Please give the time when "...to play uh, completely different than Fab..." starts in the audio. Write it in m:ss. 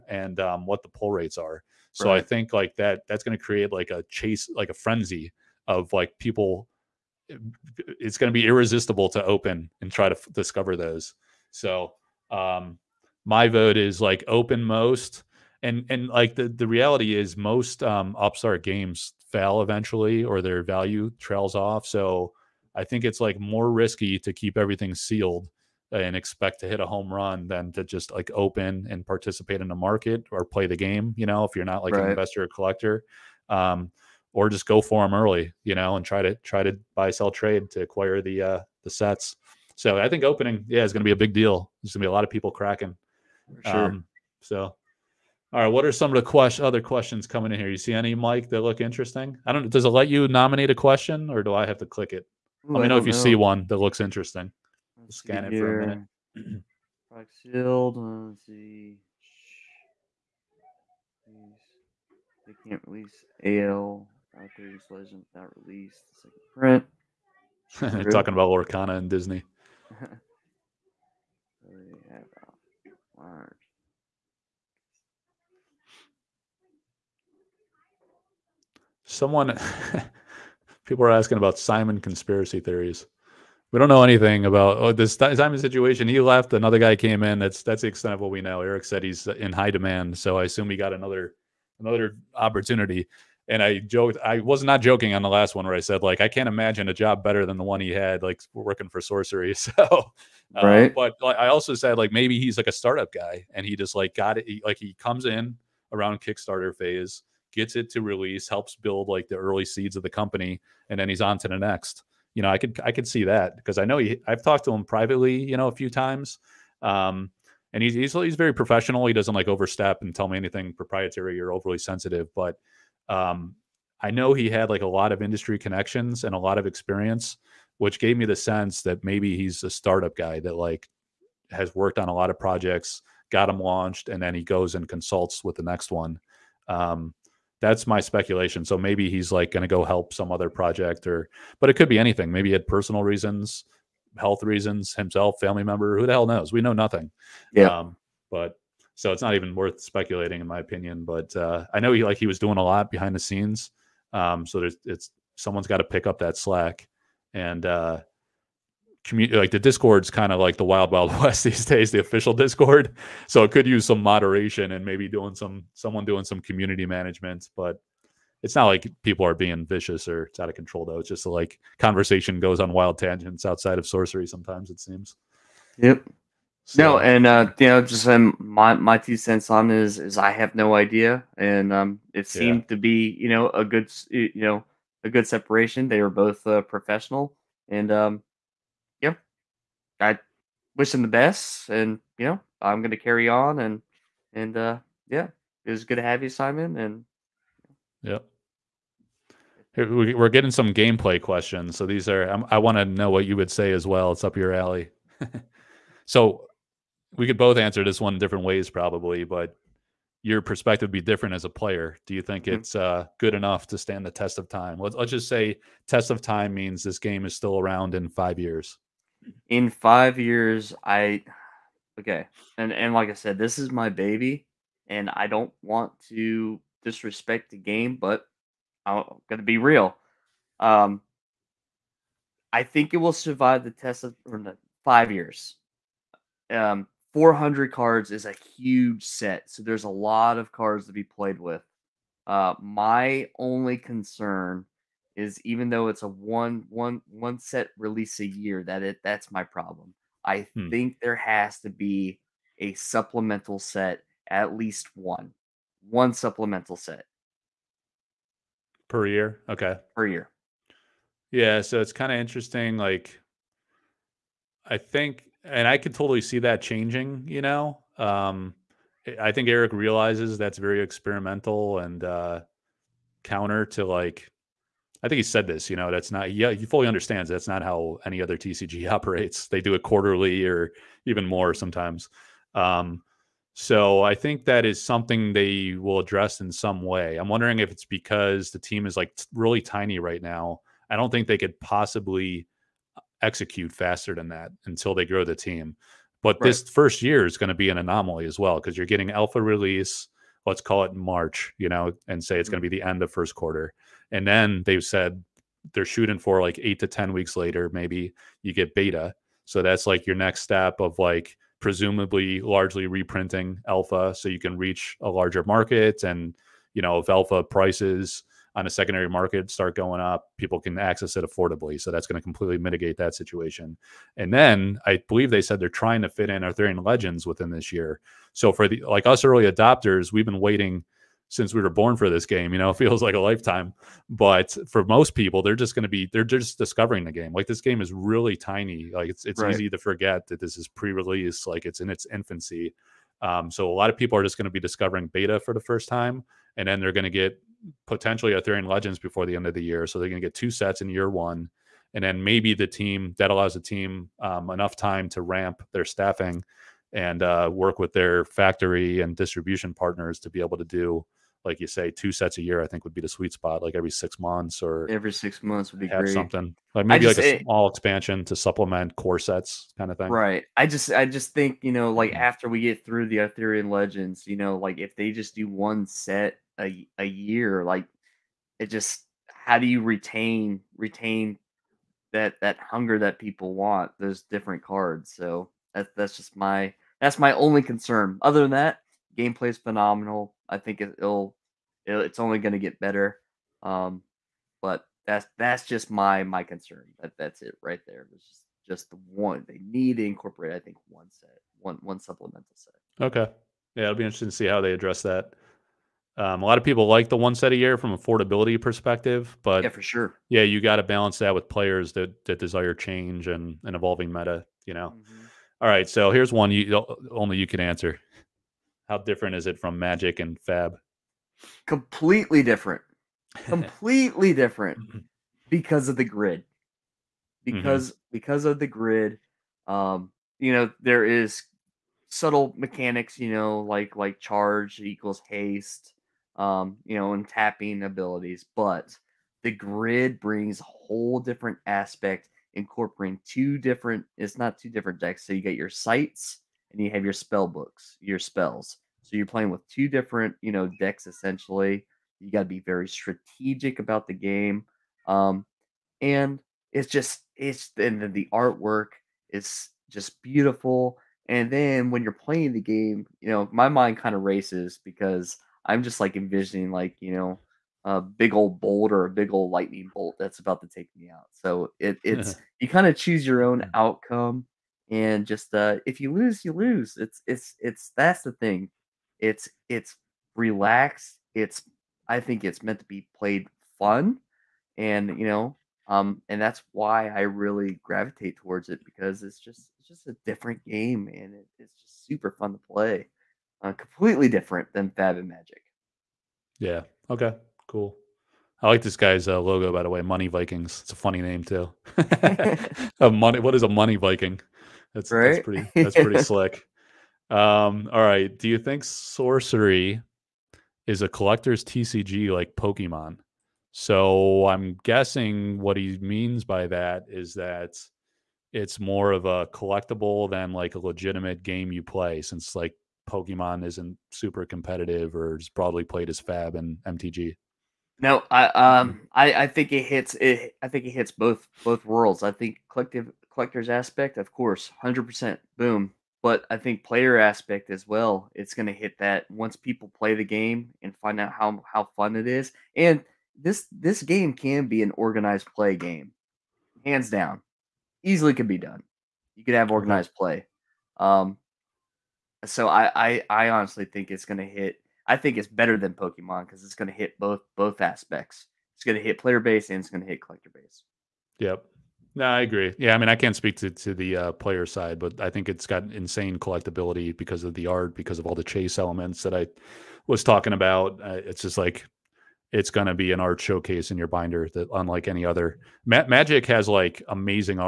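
8:12.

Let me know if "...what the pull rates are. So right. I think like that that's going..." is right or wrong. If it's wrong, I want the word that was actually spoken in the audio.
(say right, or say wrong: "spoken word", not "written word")
right.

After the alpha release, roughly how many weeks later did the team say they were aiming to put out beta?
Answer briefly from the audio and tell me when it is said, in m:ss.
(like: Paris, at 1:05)
8 to 10 weeks, at 5:06.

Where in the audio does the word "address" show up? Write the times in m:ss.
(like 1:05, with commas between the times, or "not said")
4:45, 6:44.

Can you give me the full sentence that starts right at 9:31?
Uh, it's just like it's going to be an art showcase in your binder that unlike any other.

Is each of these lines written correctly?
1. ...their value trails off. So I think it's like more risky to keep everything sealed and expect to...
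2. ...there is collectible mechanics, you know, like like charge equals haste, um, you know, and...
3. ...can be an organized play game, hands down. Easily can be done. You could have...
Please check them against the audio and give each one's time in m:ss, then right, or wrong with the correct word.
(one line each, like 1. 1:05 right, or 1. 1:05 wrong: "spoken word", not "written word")
1. 0:20 right
2. 7:10 wrong: "subtle", not "collectible"
3. 9:04 right.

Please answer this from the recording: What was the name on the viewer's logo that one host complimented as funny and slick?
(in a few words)
Money Vikings.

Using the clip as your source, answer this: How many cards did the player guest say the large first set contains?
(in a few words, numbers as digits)
400.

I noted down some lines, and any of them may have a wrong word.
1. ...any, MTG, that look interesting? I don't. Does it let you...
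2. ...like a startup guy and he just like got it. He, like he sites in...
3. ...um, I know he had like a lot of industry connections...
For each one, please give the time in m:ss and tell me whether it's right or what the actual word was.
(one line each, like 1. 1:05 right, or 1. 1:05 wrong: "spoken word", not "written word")
1. 0:47 wrong: "Mike", not "MTG"
2. 1:42 wrong: "comes", not "sites"
3. 2:03 right.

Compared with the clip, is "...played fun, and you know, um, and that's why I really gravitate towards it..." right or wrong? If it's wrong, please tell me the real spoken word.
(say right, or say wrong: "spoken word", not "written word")
right.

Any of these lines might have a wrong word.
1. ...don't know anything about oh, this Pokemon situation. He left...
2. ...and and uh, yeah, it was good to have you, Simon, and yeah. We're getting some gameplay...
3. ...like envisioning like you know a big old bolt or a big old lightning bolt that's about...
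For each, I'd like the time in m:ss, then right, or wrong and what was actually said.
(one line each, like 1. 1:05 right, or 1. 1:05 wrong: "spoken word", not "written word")
1. 1:23 wrong: "Simon", not "Pokemon"
2. 3:13 right
3. 7:45 right.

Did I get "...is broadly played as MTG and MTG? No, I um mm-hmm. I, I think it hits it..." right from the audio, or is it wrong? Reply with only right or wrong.
wrong.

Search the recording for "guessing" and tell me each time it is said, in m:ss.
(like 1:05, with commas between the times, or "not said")
8:34.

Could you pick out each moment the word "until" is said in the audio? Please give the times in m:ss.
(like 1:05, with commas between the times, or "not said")
4:54.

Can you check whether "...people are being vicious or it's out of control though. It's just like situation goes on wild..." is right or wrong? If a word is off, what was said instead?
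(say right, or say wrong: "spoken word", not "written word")
wrong: "conversation", not "situation".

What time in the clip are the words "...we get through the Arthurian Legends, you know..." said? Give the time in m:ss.
6:12.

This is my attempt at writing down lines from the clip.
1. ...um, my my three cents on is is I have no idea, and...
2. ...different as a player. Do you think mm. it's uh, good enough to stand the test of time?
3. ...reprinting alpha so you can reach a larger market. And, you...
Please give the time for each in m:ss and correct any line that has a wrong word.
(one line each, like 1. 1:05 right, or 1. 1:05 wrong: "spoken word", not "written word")
1. 2:58 wrong: "two", not "three"
2. 3:30 right
3. 5:12 right.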